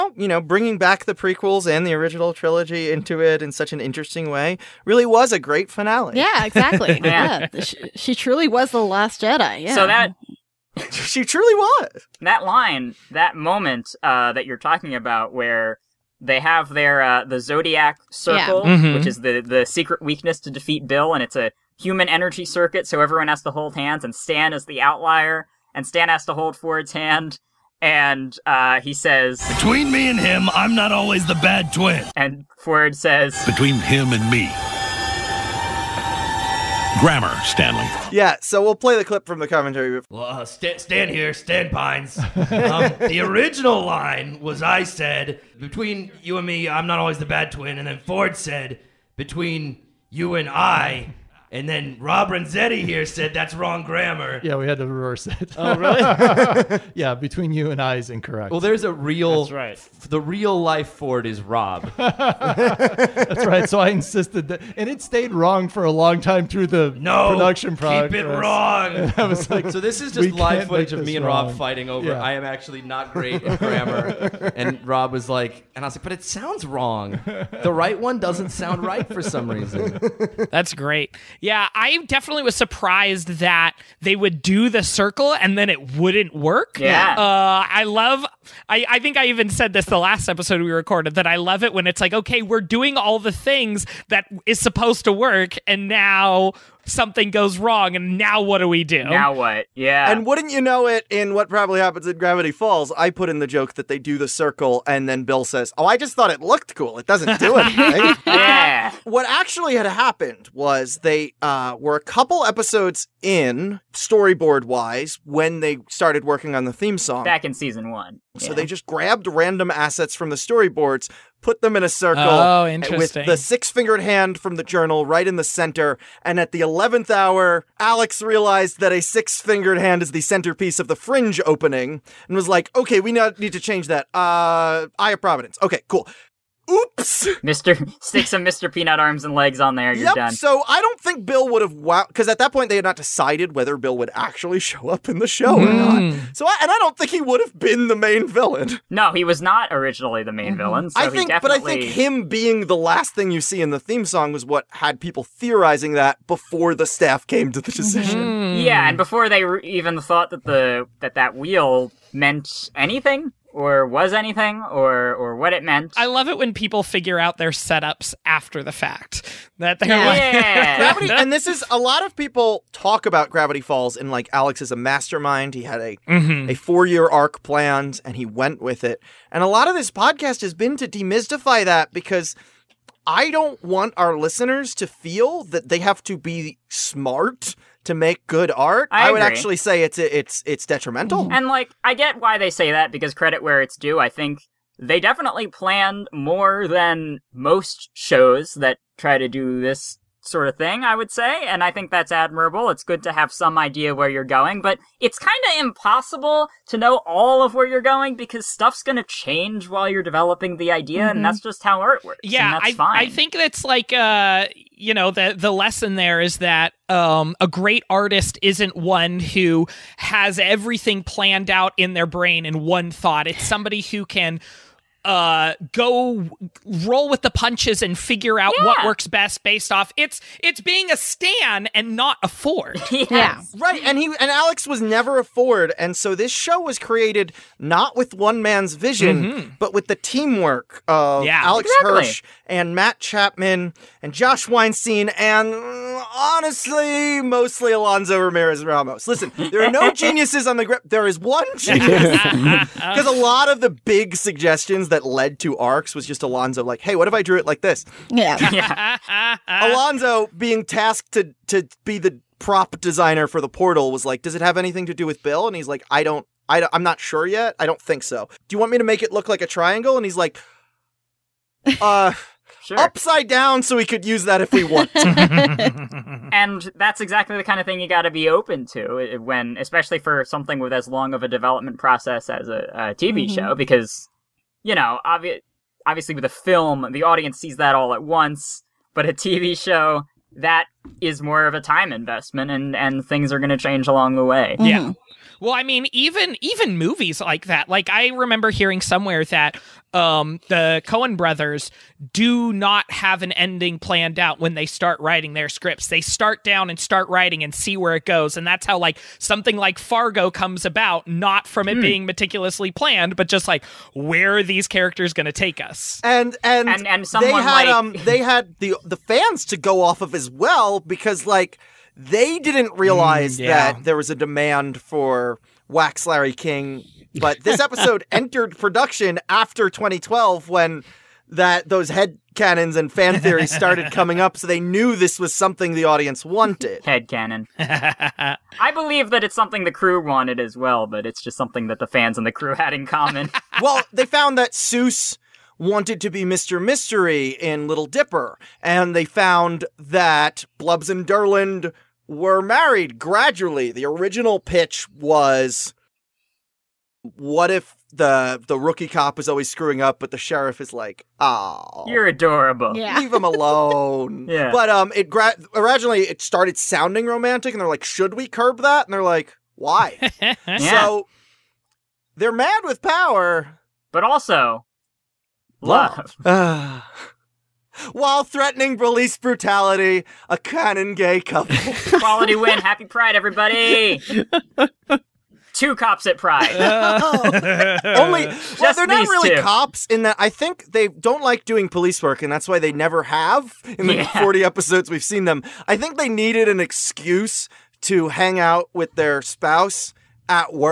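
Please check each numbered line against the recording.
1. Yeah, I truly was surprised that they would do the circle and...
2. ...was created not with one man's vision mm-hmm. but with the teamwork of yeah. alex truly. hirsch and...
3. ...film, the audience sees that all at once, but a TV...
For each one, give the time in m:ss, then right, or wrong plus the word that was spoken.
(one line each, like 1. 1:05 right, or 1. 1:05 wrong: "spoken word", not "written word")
1. 1:21 wrong: "definitely", not "truly"
2. 3:56 wrong: "exactly", not "truly"
3. 4:46 right.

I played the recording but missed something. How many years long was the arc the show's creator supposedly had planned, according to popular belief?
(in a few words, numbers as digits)
4.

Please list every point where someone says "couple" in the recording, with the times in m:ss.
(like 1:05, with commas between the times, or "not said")
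1:52, 6:21.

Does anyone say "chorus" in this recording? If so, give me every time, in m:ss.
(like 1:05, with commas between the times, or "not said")
not said.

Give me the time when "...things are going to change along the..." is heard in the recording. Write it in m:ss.
4:53.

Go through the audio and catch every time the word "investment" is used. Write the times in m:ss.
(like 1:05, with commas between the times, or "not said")
4:51.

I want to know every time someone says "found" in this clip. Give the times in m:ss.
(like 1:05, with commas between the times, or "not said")
5:44, 5:49.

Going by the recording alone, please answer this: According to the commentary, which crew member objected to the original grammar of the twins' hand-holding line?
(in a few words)
Rob Renzetti.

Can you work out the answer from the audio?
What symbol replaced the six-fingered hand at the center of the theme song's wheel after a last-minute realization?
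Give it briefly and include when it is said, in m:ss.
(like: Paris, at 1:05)
Eye of Providence, at 2:14.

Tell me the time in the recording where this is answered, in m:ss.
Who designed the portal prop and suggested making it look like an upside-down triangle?
4:07.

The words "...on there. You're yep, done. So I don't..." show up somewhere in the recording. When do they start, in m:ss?
2:19.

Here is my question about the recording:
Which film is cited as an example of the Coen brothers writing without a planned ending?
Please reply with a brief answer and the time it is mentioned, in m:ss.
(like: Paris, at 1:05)
Fargo, at 5:09.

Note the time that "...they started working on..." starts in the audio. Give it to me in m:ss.
1:55.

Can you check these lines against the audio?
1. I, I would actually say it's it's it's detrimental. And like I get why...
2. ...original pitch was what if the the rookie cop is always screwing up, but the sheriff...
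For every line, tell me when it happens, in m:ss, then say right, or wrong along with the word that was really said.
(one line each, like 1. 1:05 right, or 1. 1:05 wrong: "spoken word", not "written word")
1. 3:08 right
2. 5:53 right.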